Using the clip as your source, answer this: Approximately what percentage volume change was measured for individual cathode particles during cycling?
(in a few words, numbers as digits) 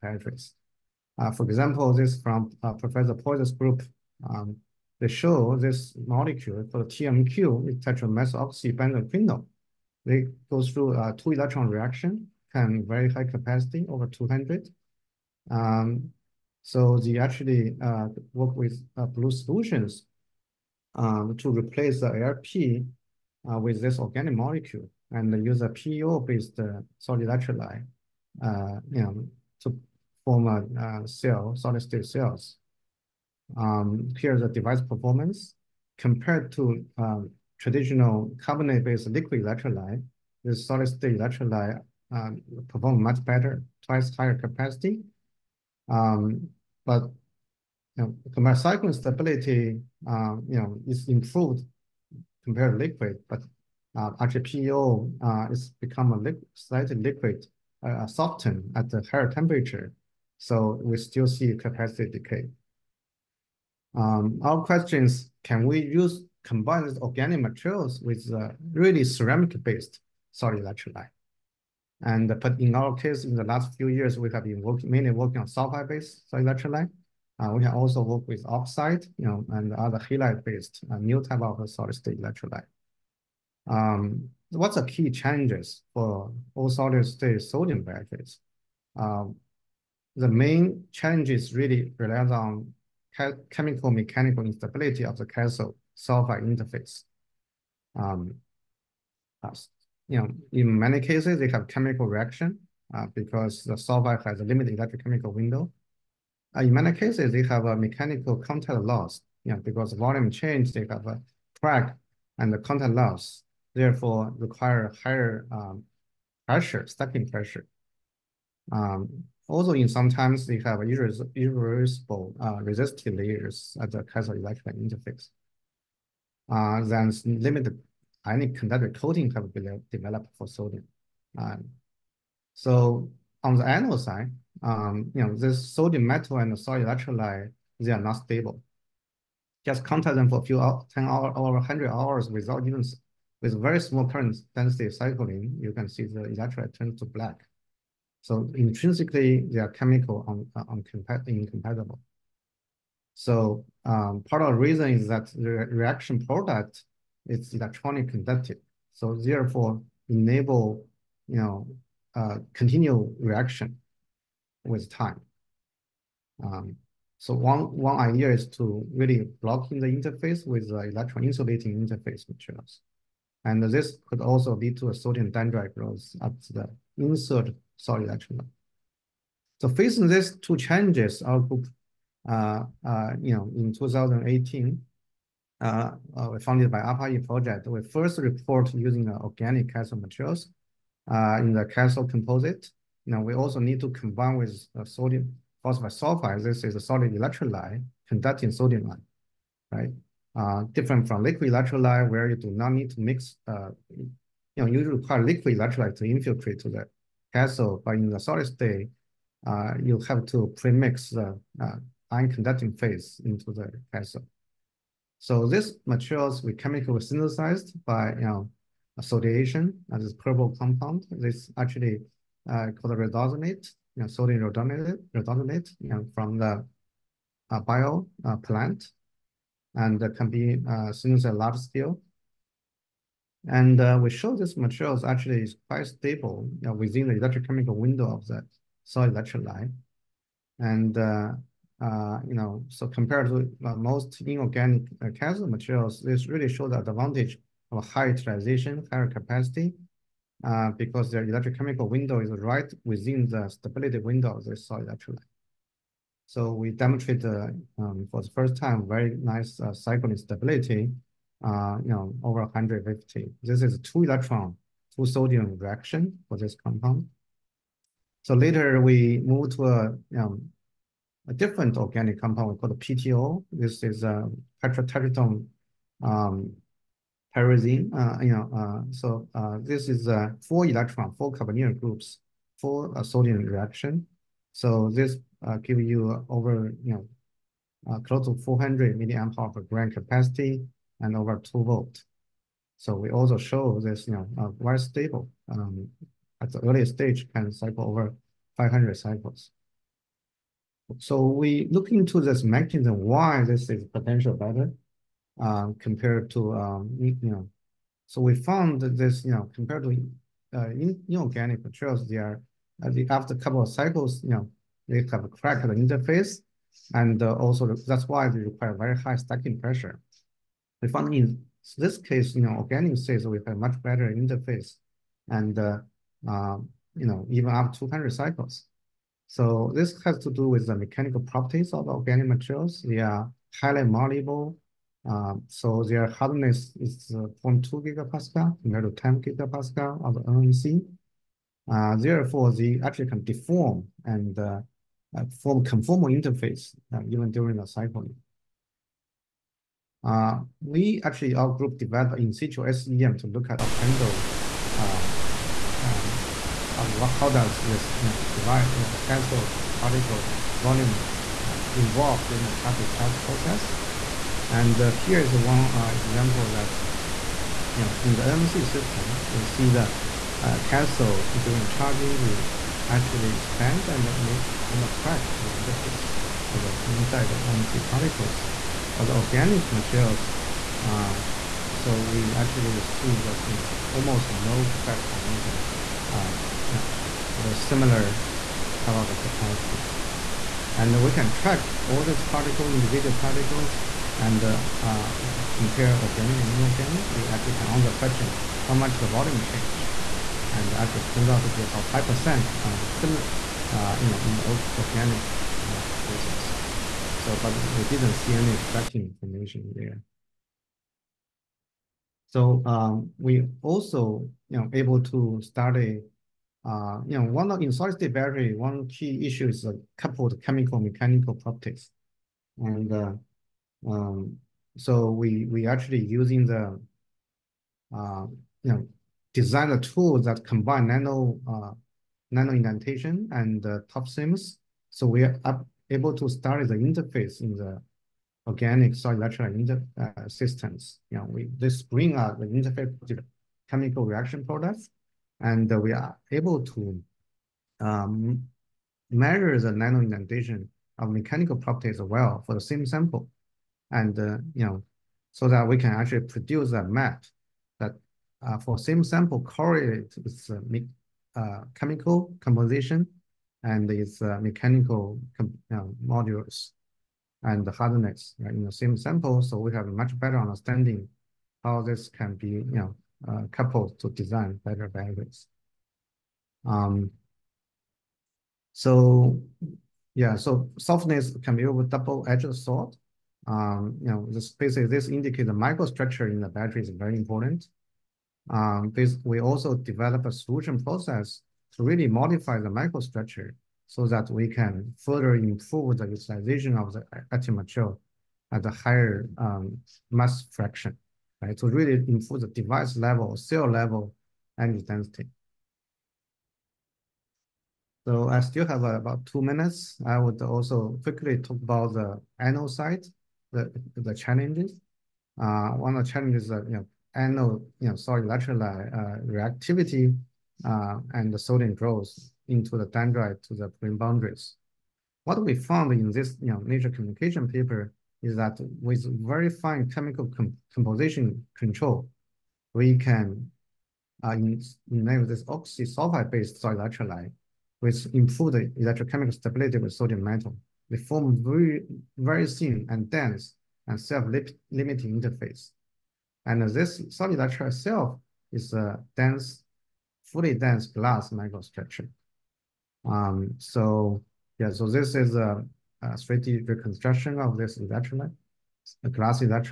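5%.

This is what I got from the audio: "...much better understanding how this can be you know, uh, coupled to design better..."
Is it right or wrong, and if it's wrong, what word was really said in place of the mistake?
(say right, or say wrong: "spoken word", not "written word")
right.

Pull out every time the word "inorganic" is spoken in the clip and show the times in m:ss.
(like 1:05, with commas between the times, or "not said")
4:04, 5:11, 6:36.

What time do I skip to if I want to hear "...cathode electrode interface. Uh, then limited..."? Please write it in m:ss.
2:04.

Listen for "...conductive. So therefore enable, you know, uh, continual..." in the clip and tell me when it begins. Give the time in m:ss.
2:38.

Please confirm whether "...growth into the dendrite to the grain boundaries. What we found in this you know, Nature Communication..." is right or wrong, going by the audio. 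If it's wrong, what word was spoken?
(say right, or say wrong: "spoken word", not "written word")
right.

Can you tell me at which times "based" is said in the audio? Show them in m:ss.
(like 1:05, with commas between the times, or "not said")
0:25, 0:38, 1:09, 1:15, 1:19, 8:55.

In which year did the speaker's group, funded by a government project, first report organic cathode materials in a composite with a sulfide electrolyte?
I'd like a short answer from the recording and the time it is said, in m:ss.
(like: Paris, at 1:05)
2018, at 3:03.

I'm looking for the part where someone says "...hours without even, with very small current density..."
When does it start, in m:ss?
2:21.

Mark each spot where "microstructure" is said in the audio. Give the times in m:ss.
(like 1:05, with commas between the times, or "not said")
8:05, 8:12, 9:11.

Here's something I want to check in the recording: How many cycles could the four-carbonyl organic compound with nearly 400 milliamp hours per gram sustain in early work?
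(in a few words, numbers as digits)
500.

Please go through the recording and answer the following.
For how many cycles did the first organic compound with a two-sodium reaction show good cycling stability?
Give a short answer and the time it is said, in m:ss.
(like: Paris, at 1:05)
150, at 4:22.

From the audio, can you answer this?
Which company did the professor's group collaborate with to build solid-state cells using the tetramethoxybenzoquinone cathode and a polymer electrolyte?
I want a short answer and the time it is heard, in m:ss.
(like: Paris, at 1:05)
Blue Solutions, at 0:19.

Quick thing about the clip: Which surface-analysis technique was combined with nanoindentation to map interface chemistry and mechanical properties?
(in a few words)
ToF-SIMS.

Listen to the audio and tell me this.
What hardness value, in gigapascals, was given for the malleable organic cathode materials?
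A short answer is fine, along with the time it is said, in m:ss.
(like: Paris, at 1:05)
0.2 gigapascal, at 5:37.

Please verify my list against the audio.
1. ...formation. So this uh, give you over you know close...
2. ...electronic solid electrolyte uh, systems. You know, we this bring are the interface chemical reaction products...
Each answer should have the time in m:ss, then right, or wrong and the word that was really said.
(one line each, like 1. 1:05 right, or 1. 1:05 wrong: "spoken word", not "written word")
1. 4:43 wrong: "reaction", not "formation"
2. 7:18 wrong: "organic", not "electronic".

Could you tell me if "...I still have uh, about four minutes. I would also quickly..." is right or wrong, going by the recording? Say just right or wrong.
wrong.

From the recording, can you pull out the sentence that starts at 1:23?
Um, what's the key challenges for all solid-state sodium batteries?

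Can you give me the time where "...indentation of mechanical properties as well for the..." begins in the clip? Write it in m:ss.
7:30.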